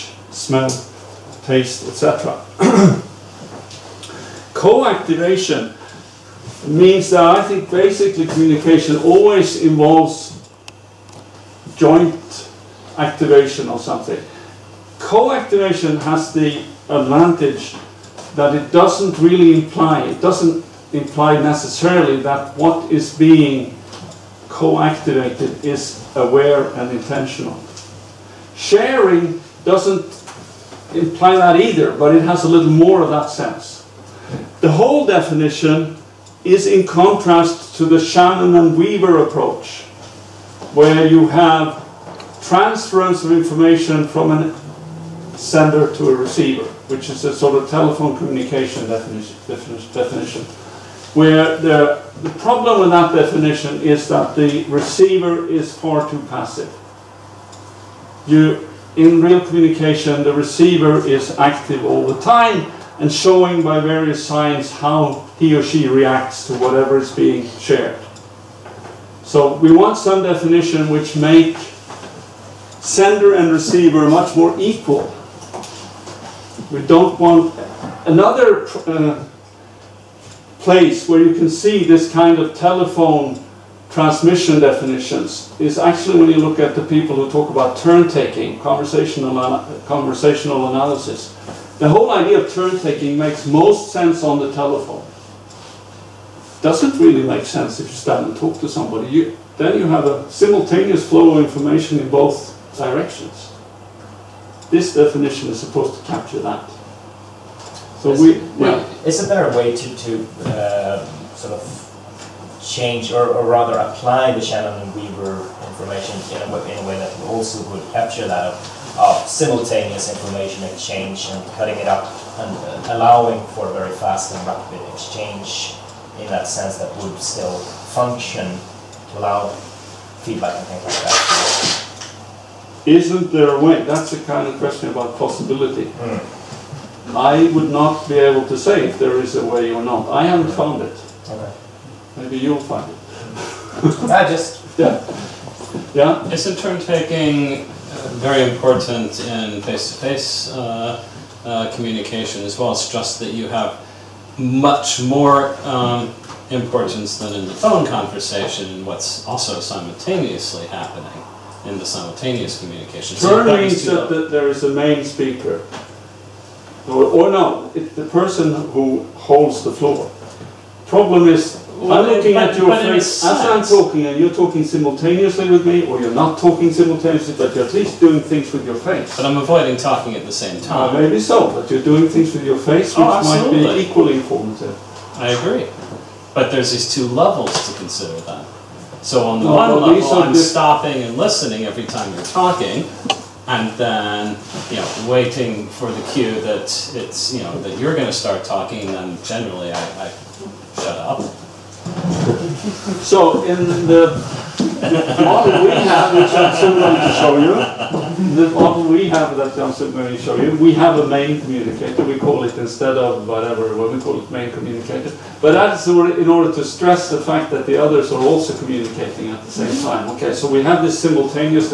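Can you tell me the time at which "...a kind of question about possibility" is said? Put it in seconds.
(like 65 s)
134 s.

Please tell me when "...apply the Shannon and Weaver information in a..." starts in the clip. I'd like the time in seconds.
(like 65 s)
113 s.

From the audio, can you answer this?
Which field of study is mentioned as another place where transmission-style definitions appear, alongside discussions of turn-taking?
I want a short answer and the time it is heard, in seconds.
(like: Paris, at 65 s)
conversational analysis, at 89 s.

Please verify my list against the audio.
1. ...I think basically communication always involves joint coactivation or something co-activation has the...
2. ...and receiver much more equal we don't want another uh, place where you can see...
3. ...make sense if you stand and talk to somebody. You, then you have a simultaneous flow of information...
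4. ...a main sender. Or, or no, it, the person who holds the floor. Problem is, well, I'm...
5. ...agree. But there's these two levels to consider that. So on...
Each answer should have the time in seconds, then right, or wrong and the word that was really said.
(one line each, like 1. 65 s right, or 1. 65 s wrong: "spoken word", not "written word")
1. 7 s wrong: "activation", not "coactivation"
2. 73 s right
3. 97 s right
4. 164 s wrong: "speaker", not "sender"
5. 185 s right.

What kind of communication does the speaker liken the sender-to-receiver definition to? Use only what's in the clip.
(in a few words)
telephone communication.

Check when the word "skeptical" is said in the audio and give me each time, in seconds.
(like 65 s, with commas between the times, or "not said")
not said.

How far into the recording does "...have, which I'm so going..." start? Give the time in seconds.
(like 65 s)
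205 s.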